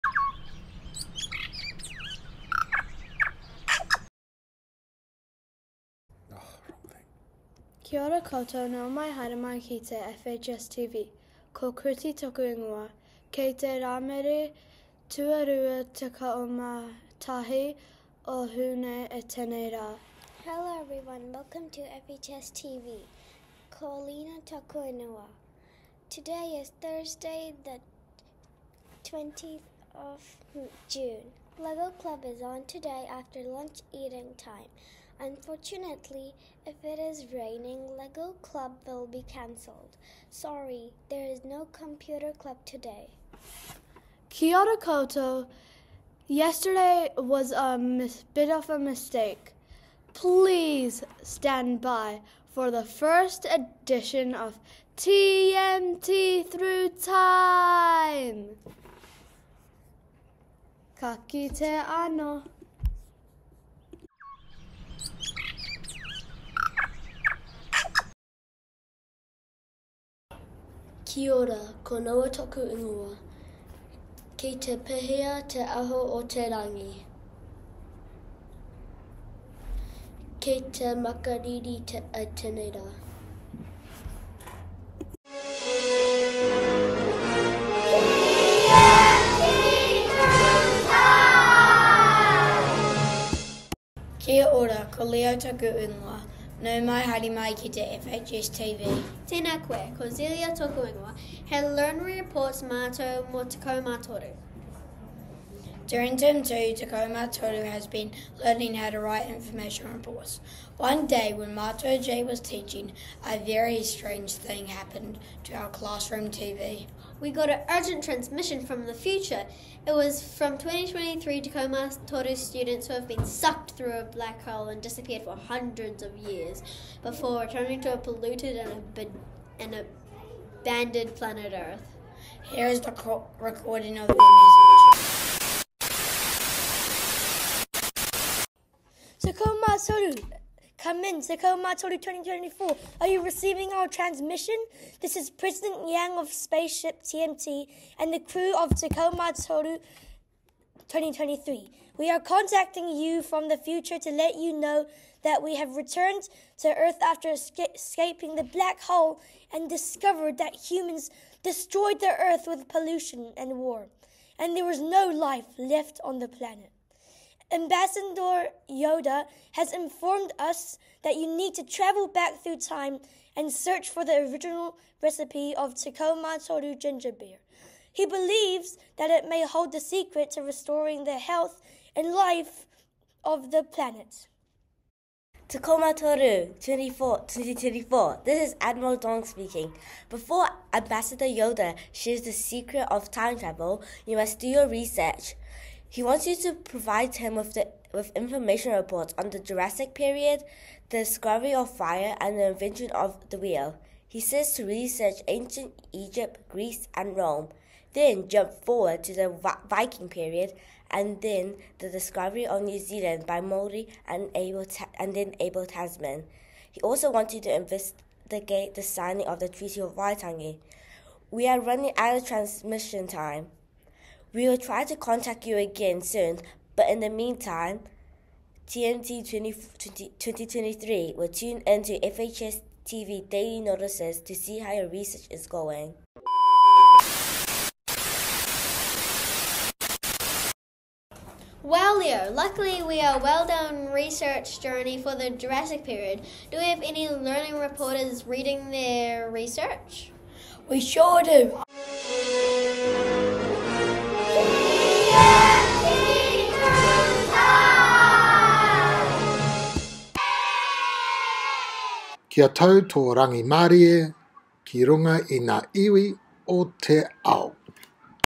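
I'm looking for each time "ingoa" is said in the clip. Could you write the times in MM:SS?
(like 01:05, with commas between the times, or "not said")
00:12, 00:24, 01:12, 01:35, 01:40.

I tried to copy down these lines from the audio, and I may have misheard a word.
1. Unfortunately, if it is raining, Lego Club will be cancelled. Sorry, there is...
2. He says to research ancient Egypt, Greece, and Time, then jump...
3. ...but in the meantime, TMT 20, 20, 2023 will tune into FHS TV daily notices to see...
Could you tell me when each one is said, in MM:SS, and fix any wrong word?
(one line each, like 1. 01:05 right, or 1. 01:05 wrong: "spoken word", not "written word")
1. 00:35 right
2. 03:24 wrong: "Rome", not "Time"
3. 03:46 right.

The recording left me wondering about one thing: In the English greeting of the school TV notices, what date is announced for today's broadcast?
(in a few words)
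Thursday the 20th of June.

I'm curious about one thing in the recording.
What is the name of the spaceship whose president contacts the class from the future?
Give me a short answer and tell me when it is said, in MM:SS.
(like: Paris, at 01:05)
Spaceship TMT, at 02:26.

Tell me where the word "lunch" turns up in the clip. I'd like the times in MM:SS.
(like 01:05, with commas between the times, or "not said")
00:33.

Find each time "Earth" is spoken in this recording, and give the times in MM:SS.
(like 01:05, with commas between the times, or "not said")
02:11, 02:36, 02:42.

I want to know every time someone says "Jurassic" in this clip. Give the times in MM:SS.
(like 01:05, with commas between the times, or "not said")
03:19, 04:05.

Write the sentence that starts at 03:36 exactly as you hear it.
He also wants you to investigate the signing of the Treaty of Waitangi.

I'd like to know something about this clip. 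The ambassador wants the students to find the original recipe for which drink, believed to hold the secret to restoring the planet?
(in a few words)
Tacoma Toru ginger beer.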